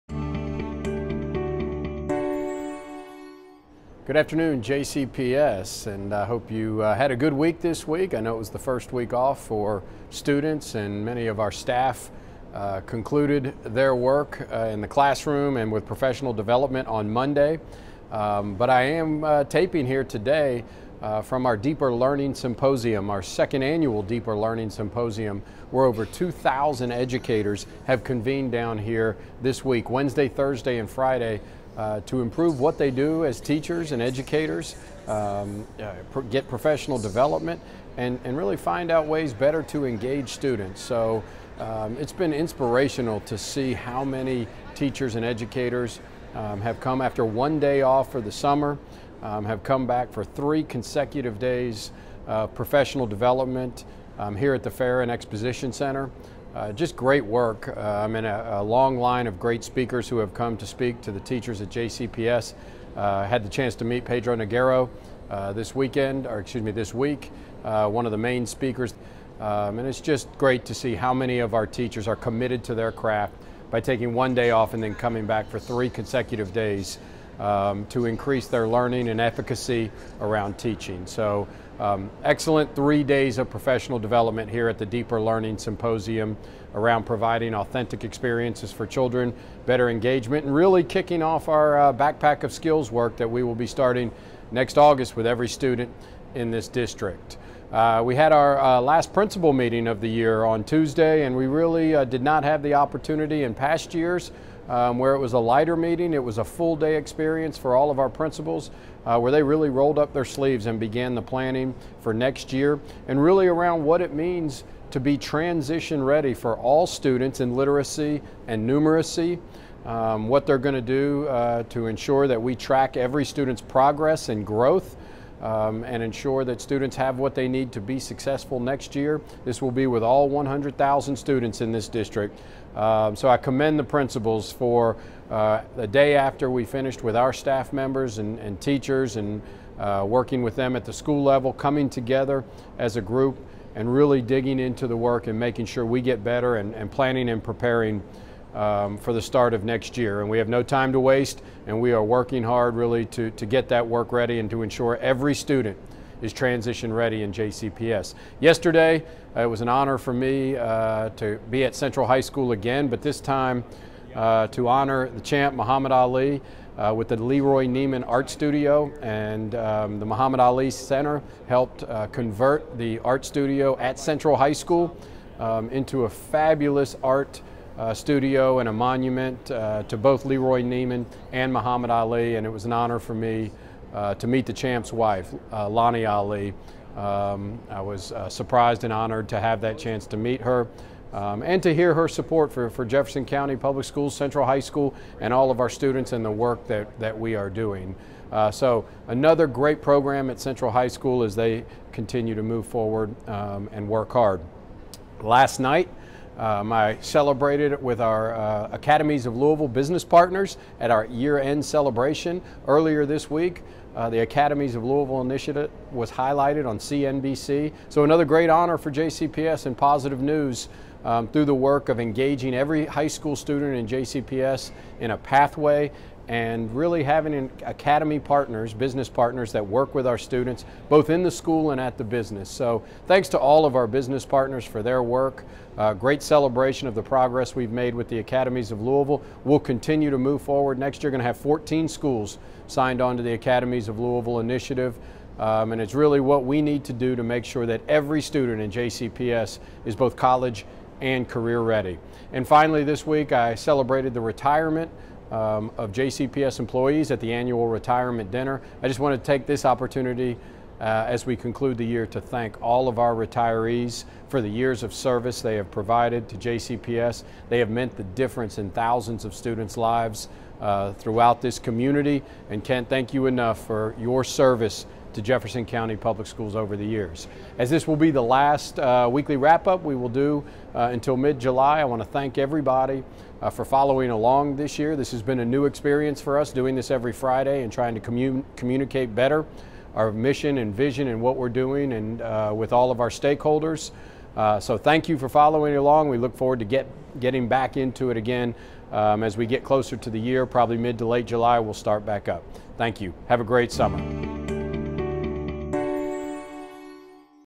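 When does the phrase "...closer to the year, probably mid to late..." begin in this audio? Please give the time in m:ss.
4:59.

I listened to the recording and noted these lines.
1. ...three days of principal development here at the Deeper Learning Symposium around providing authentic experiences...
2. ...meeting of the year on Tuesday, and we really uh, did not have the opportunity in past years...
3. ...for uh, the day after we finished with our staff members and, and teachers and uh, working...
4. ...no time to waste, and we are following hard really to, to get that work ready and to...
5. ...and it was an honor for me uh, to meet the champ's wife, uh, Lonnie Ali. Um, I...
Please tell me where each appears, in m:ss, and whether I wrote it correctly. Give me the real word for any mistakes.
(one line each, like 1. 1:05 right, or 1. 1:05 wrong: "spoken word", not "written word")
1. 1:22 wrong: "professional", not "principal"
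2. 1:39 right
3. 2:14 right
4. 2:30 wrong: "working", not "following"
5. 3:02 right.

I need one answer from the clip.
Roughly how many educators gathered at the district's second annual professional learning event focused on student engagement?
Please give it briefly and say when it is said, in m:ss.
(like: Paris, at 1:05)
2,000, at 0:26.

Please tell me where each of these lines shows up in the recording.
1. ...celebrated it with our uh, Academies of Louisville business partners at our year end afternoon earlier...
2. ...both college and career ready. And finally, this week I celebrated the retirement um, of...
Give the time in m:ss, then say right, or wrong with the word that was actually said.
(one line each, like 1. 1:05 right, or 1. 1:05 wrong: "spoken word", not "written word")
1. 3:27 wrong: "celebration", not "afternoon"
2. 4:09 right.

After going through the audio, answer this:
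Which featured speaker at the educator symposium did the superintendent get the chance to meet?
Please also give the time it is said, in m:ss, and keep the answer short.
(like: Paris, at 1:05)
Pedro Noguera, at 1:04.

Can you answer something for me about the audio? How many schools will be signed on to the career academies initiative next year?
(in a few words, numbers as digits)
14.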